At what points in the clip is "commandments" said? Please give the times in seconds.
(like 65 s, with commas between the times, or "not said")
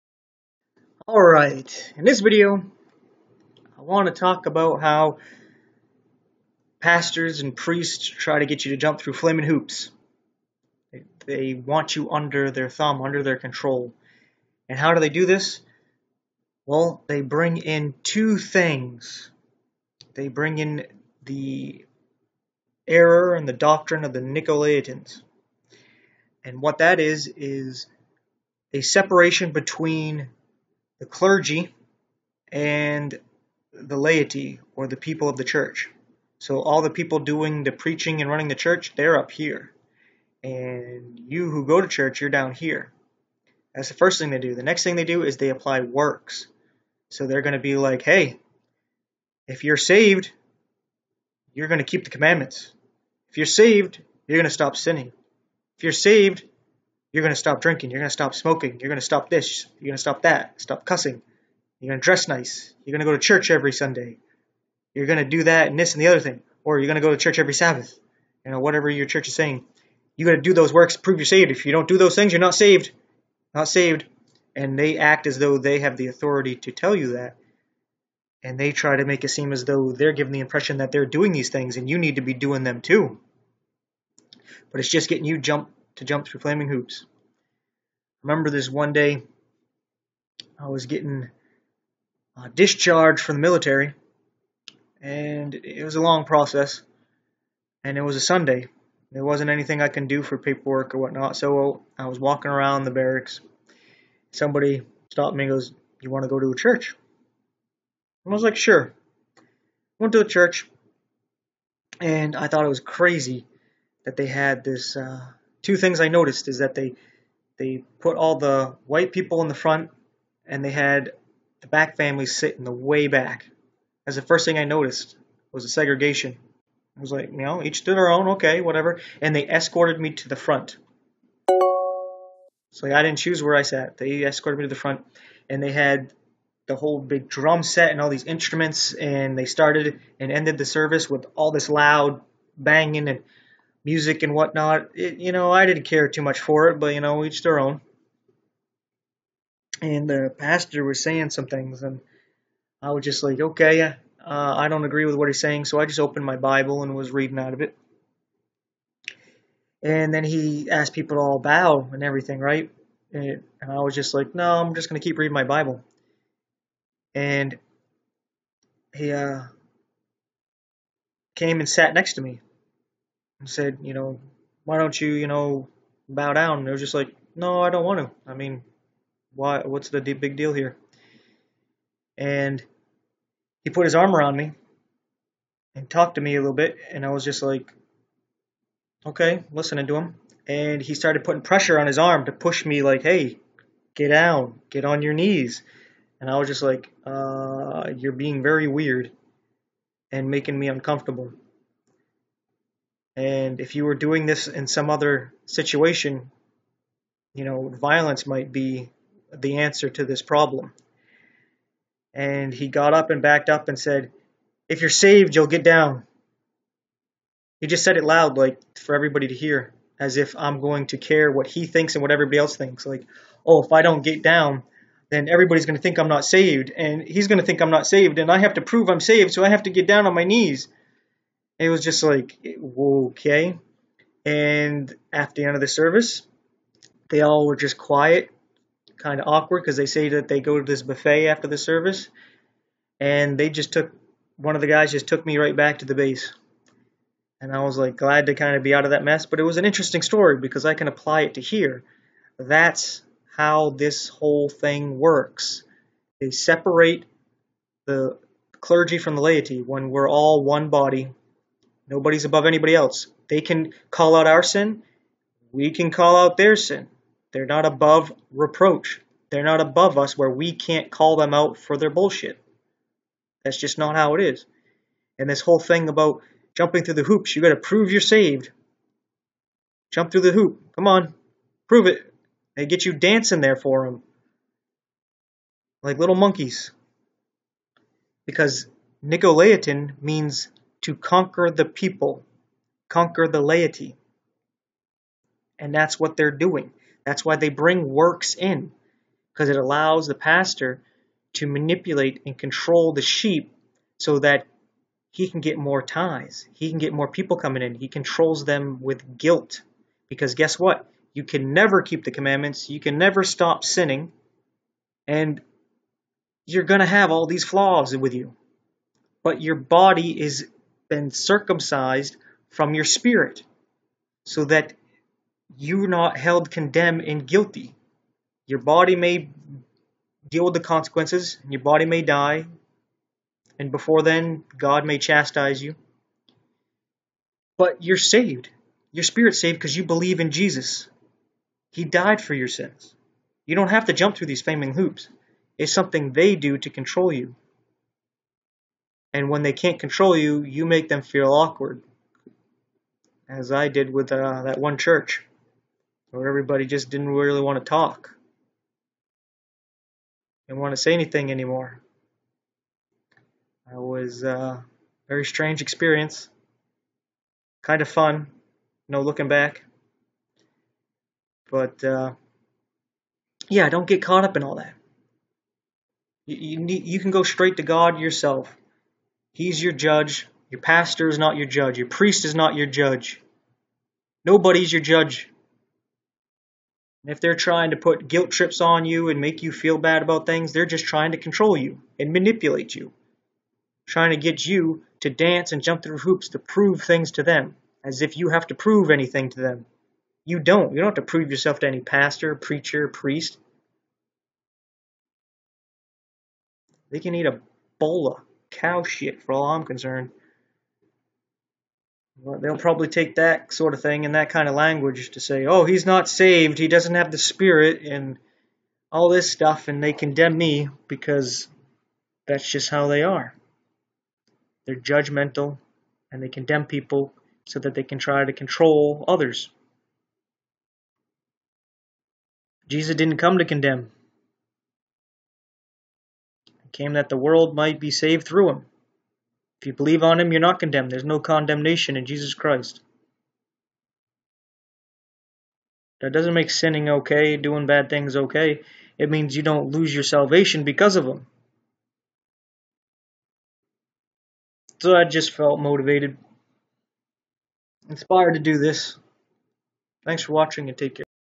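52 s, 312 s.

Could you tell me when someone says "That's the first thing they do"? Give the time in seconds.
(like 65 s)
43 s.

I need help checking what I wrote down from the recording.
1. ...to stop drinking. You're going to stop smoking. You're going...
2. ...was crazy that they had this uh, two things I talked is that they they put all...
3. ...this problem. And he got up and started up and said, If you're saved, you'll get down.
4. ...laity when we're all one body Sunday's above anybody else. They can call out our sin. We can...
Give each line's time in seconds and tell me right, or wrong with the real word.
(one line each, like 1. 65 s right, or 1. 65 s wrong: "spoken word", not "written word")
1. 57 s right
2. 112 s wrong: "noticed", not "talked"
3. 210 s wrong: "backed", not "started"
4. 259 s wrong: "Nobody", not "Sunday".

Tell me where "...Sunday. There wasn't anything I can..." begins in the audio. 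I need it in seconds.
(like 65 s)
98 s.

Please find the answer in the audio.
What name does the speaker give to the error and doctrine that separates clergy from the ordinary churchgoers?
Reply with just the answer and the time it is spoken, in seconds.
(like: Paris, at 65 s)
The Nicolaitans, at 24 s.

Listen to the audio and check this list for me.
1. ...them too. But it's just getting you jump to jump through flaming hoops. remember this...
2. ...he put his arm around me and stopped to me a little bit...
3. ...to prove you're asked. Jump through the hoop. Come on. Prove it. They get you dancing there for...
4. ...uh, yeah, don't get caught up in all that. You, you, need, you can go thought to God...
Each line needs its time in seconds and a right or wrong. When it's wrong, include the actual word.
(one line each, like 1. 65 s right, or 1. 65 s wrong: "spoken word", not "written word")
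1. 82 s right
2. 183 s wrong: "talked", not "stopped"
3. 277 s wrong: "saved", not "asked"
4. 371 s wrong: "straight", not "thought".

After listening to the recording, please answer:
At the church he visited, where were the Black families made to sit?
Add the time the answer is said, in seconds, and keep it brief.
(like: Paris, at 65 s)
In the way back, at 122 s.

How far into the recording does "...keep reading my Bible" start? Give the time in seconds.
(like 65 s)
165 s.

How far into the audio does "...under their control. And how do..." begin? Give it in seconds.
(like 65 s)
13 s.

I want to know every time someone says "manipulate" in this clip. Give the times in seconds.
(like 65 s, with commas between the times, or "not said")
301 s, 392 s.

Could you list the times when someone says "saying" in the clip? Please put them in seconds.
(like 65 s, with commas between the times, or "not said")
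69 s, 151 s, 155 s.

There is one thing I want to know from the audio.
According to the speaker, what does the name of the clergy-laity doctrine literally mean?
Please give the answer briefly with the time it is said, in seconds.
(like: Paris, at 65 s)
To conquer the people, at 290 s.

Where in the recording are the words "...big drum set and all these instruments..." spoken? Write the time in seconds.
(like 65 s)
136 s.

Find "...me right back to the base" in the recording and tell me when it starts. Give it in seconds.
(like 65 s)
245 s.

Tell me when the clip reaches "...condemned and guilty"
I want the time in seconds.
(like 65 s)
326 s.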